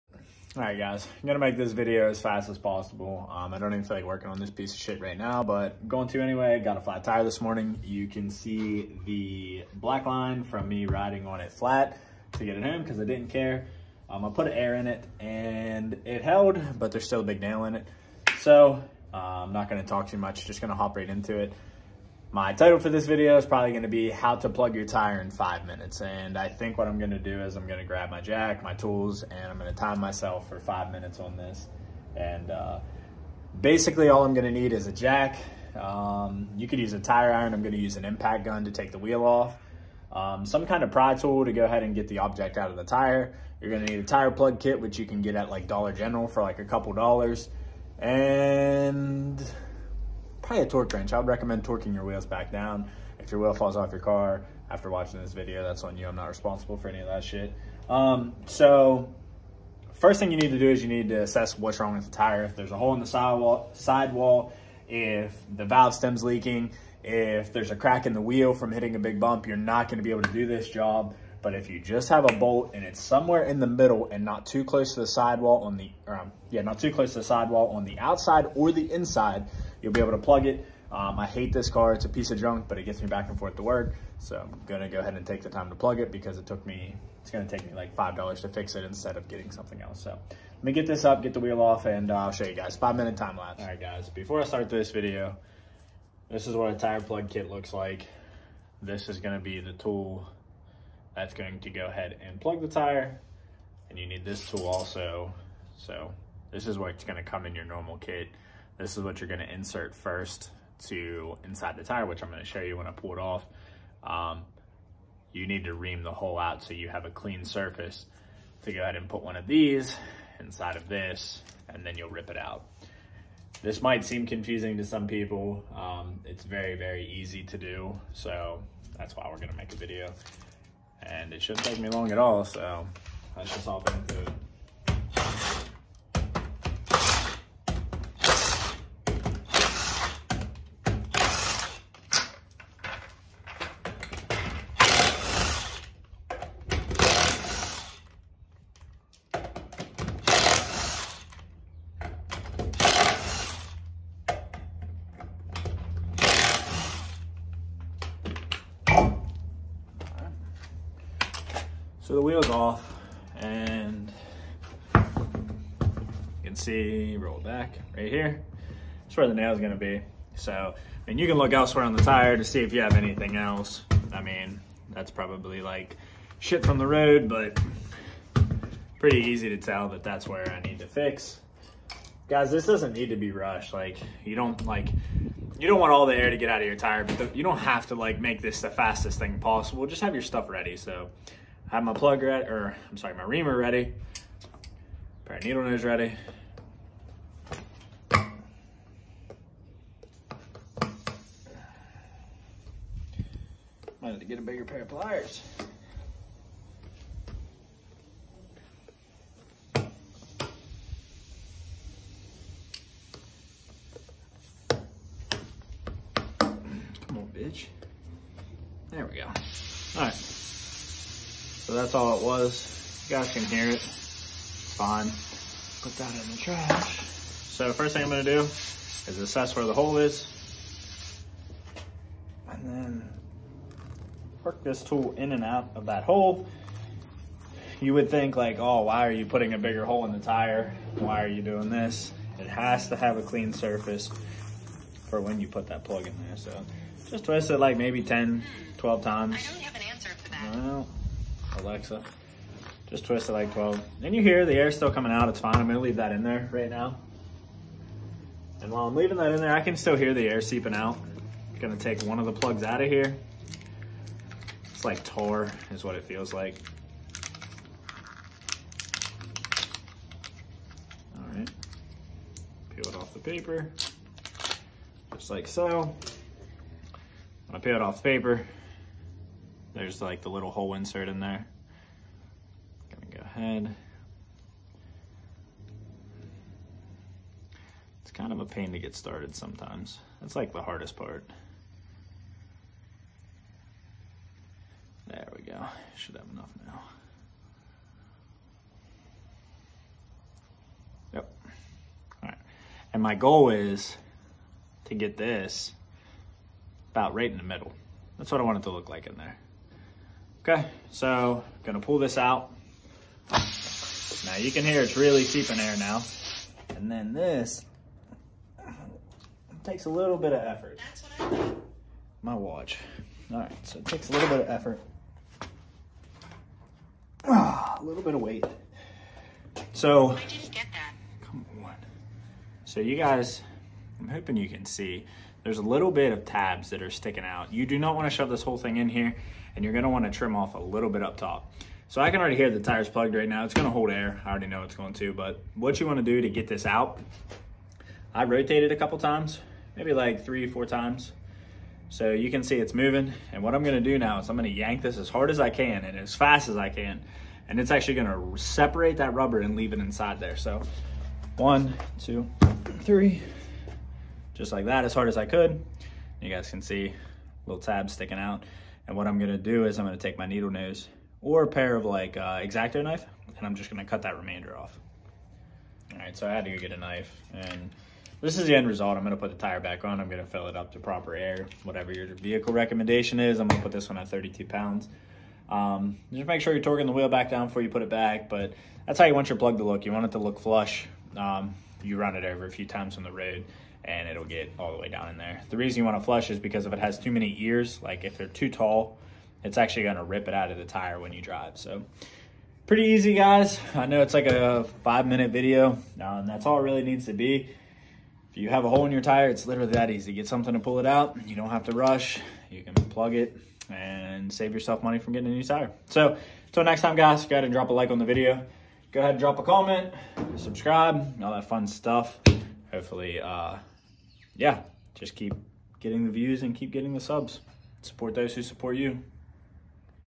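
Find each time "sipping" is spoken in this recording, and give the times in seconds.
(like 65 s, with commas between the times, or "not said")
not said.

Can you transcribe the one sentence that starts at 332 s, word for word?
So you guys, I'm hoping you can see there's a little bit of tabs that are sticking out.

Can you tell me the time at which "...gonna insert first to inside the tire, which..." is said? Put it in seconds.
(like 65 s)
109 s.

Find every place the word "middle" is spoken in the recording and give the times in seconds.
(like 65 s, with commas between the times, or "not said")
73 s, 307 s.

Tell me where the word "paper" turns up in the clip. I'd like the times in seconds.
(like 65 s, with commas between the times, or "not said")
273 s, 278 s.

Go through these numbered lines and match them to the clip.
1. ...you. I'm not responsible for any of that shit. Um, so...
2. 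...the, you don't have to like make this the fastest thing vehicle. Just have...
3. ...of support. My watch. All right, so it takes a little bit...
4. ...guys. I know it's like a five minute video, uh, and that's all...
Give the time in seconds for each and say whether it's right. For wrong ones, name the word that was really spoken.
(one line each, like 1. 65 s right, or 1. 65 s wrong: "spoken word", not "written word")
1. 55 s right
2. 187 s wrong: "possible", not "vehicle"
3. 320 s wrong: "effort", not "support"
4. 403 s right.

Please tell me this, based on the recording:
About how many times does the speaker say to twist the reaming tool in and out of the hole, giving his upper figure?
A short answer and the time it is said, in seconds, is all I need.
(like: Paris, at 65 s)
12, at 248 s.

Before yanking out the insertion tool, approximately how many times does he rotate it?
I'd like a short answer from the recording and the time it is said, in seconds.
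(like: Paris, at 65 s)
3 or 4, at 350 s.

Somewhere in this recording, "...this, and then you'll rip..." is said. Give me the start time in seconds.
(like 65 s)
120 s.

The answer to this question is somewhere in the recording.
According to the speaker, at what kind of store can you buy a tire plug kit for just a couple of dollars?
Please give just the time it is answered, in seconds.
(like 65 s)
45 s.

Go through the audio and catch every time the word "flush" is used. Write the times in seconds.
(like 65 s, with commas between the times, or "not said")
390 s, 396 s.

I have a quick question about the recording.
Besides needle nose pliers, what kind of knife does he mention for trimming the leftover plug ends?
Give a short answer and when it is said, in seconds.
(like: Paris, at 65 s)
X-Acto knife, at 372 s.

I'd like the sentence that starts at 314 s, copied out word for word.
Now you can hear it's really seeping air now.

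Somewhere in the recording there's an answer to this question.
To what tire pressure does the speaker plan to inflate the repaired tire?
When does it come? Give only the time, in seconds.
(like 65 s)
384 s.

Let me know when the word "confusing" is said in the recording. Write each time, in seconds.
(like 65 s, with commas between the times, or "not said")
124 s.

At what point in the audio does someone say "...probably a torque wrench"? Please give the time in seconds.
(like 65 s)
50 s.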